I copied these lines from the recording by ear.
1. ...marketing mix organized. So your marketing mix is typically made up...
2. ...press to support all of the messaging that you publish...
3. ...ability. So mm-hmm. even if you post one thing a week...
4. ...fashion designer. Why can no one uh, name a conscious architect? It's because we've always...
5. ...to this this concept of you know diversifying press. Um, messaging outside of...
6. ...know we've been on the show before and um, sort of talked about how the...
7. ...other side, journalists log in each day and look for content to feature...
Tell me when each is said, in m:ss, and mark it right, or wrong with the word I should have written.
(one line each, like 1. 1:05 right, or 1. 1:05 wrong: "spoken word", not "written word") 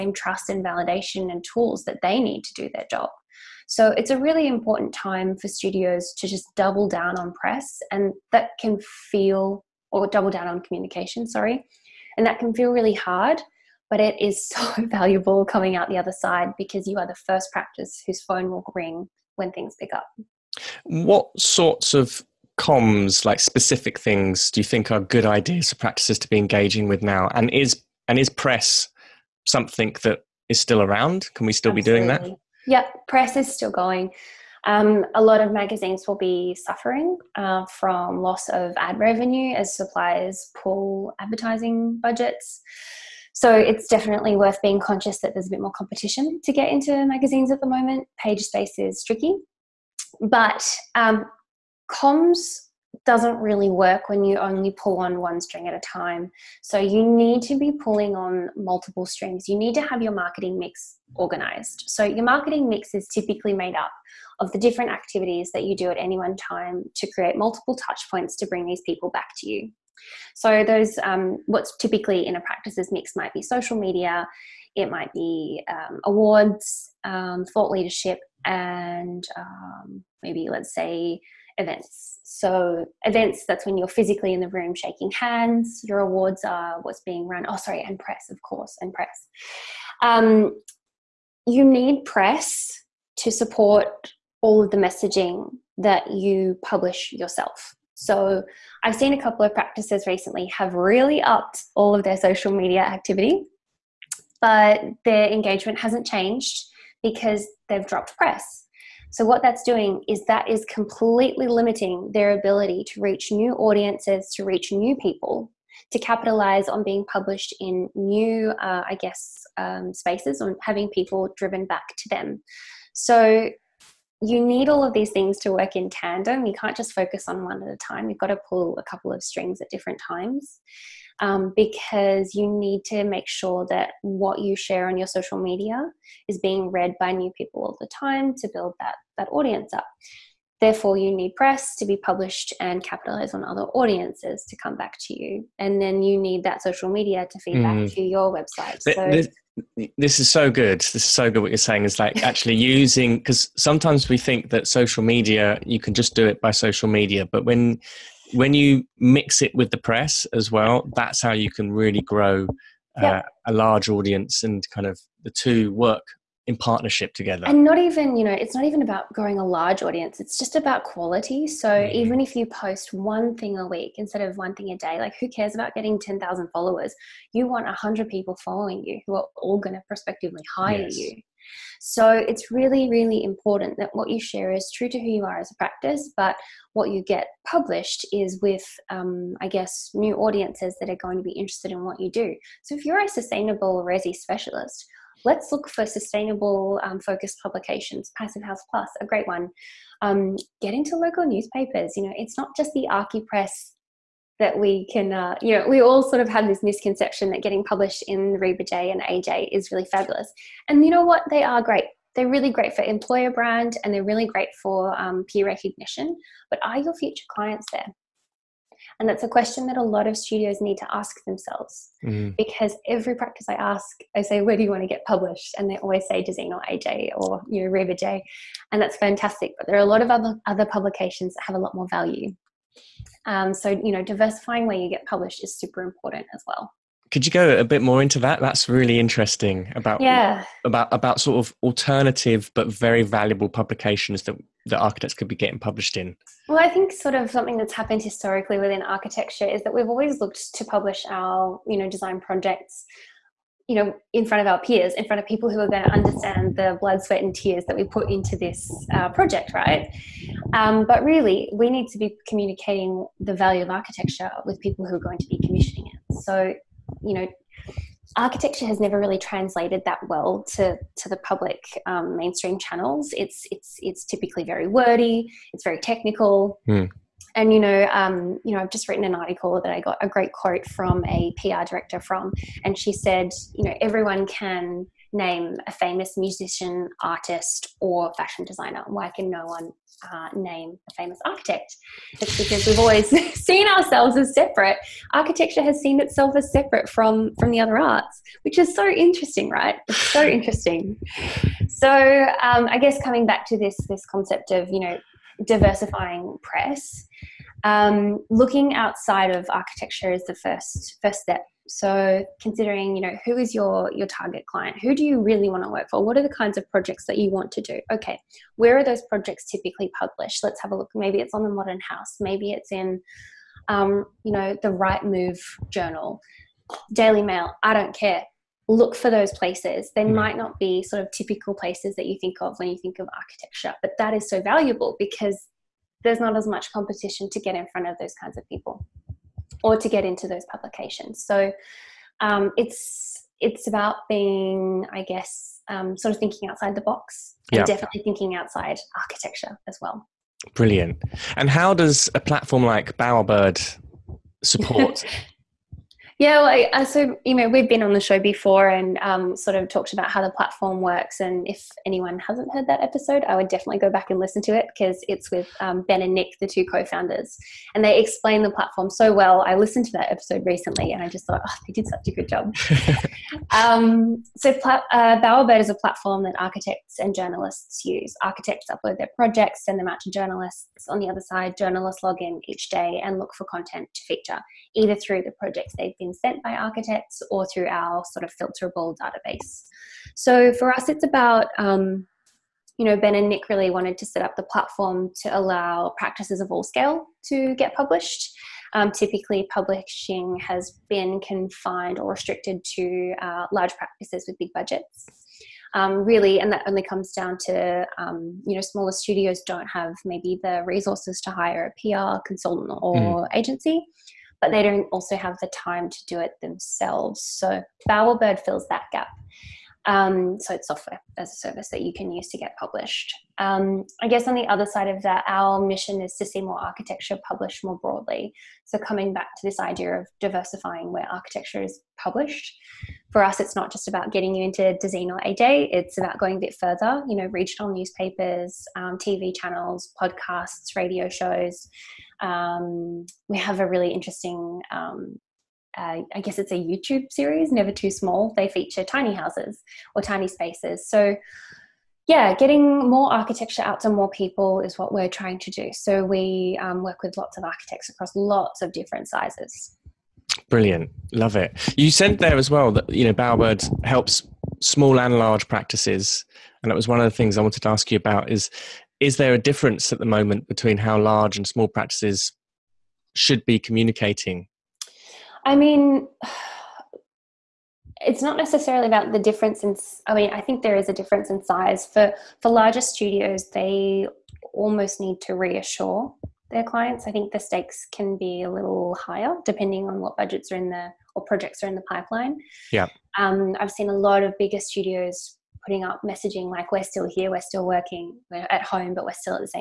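1. 1:00 right
2. 1:32 right
3. 2:50 wrong: "quality", not "ability"
4. 4:48 wrong: "famous", not "conscious"
5. 5:03 wrong: "looking", not "messaging"
6. 5:57 right
7. 6:21 right.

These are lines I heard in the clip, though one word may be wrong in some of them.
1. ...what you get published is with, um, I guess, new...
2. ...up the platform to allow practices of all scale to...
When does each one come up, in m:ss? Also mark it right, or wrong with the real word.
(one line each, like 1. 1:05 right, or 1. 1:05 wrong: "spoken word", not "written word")
1. 3:06 right
2. 6:34 right.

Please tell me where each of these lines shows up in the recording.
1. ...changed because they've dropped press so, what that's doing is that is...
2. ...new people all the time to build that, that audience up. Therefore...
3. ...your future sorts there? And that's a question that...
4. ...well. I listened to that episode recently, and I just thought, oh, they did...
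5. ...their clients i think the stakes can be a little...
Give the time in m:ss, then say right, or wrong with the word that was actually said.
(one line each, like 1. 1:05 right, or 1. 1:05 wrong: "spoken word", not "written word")
1. 1:46 right
2. 2:17 right
3. 3:36 wrong: "clients", not "sorts"
4. 6:09 right
5. 8:06 right.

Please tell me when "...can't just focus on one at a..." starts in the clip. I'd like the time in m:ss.
2:06.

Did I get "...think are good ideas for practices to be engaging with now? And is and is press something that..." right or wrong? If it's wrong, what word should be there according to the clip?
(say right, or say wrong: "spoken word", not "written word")
right.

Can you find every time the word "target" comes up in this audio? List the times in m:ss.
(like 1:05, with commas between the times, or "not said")
5:14.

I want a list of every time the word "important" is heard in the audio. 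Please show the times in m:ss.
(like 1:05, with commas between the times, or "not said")
0:04, 3:03, 3:55.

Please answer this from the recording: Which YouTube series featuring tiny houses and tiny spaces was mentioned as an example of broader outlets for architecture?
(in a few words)
Never Too Small.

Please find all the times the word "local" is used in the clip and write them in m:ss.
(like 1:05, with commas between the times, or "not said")
3:20.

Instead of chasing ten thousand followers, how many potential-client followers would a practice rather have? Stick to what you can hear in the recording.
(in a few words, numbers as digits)
100.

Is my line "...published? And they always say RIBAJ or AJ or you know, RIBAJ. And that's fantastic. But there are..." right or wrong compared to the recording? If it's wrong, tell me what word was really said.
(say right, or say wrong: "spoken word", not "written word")
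wrong: "Dezeen", not "RIBAJ".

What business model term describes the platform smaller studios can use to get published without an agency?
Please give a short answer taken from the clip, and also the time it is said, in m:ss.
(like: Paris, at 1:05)
Software as a service, at 7:00.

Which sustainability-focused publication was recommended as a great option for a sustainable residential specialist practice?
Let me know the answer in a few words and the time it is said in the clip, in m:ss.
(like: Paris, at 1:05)
Passive House Plus, at 3:18.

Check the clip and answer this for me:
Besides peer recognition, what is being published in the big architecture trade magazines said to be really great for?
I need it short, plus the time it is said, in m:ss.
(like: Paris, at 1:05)
Employer brand, at 3:32.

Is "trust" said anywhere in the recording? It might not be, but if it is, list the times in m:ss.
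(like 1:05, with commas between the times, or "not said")
0:00.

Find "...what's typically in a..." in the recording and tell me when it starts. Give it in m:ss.
1:11.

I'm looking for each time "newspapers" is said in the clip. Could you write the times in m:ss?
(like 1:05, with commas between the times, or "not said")
3:21, 7:17.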